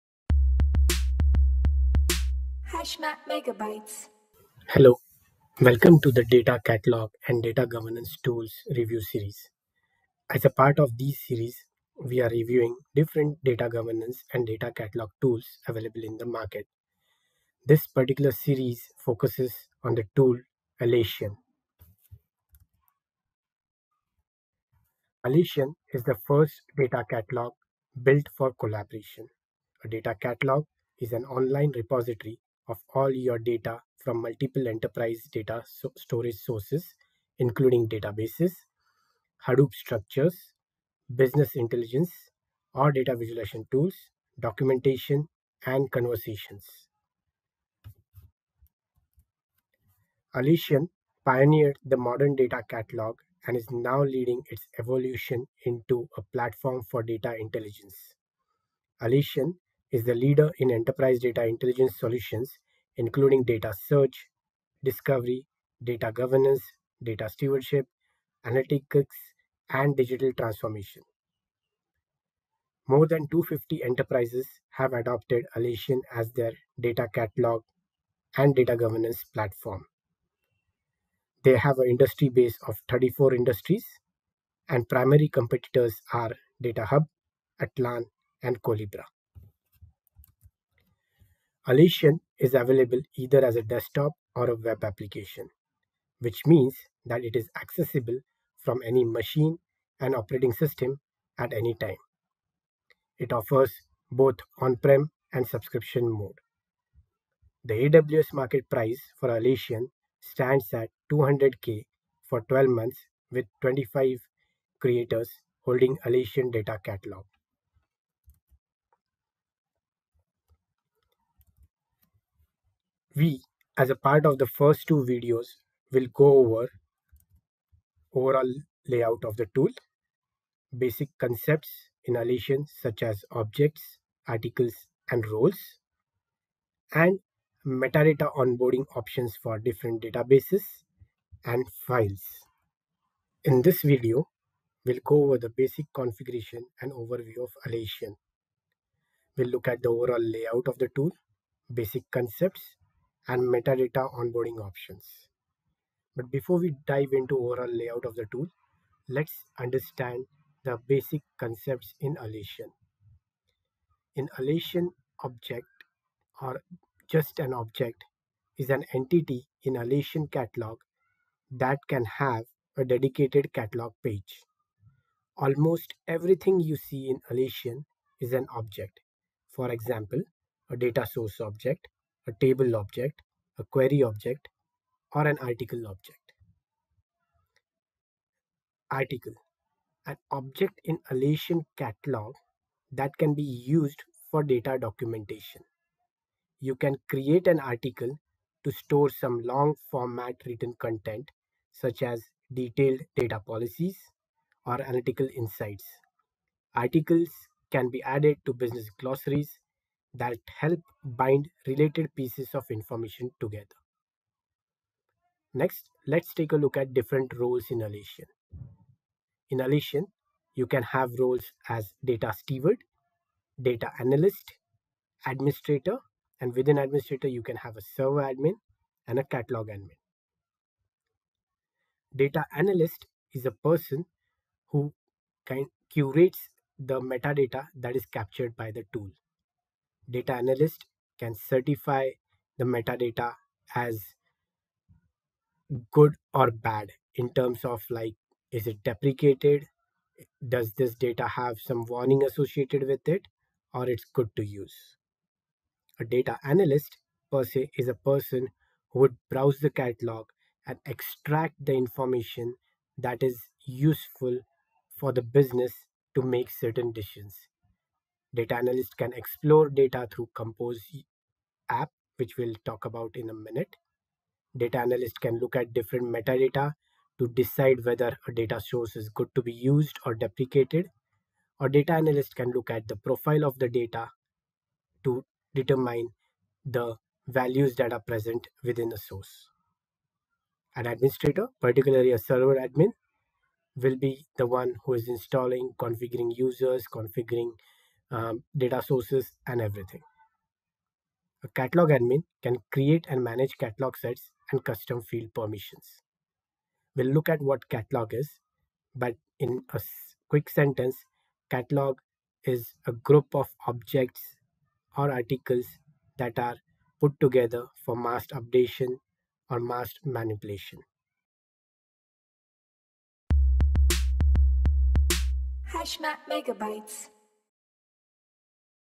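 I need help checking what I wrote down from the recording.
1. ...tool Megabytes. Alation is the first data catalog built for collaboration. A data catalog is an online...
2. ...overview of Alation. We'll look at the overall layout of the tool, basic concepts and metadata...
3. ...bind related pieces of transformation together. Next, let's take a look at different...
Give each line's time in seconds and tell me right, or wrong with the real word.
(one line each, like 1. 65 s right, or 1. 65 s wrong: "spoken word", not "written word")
1. 20 s wrong: "Alation", not "Megabytes"
2. 146 s right
3. 211 s wrong: "information", not "transformation".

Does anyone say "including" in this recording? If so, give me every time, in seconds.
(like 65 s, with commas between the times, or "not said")
37 s, 62 s.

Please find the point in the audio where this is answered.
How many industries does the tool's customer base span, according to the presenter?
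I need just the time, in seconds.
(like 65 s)
82 s.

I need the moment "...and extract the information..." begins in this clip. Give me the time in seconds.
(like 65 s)
260 s.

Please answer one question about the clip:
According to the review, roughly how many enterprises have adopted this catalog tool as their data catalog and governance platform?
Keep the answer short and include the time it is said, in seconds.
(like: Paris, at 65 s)
More than 250, at 72 s.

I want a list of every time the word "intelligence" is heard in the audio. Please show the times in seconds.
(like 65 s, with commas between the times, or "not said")
41 s, 57 s, 61 s.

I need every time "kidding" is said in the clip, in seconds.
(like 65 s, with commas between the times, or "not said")
not said.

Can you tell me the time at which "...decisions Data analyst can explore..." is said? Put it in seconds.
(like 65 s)
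266 s.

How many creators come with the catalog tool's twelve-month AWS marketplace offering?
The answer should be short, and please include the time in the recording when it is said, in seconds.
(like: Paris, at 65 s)
25, at 113 s.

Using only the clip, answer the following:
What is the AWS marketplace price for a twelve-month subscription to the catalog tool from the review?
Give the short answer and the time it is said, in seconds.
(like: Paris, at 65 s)
200k, at 111 s.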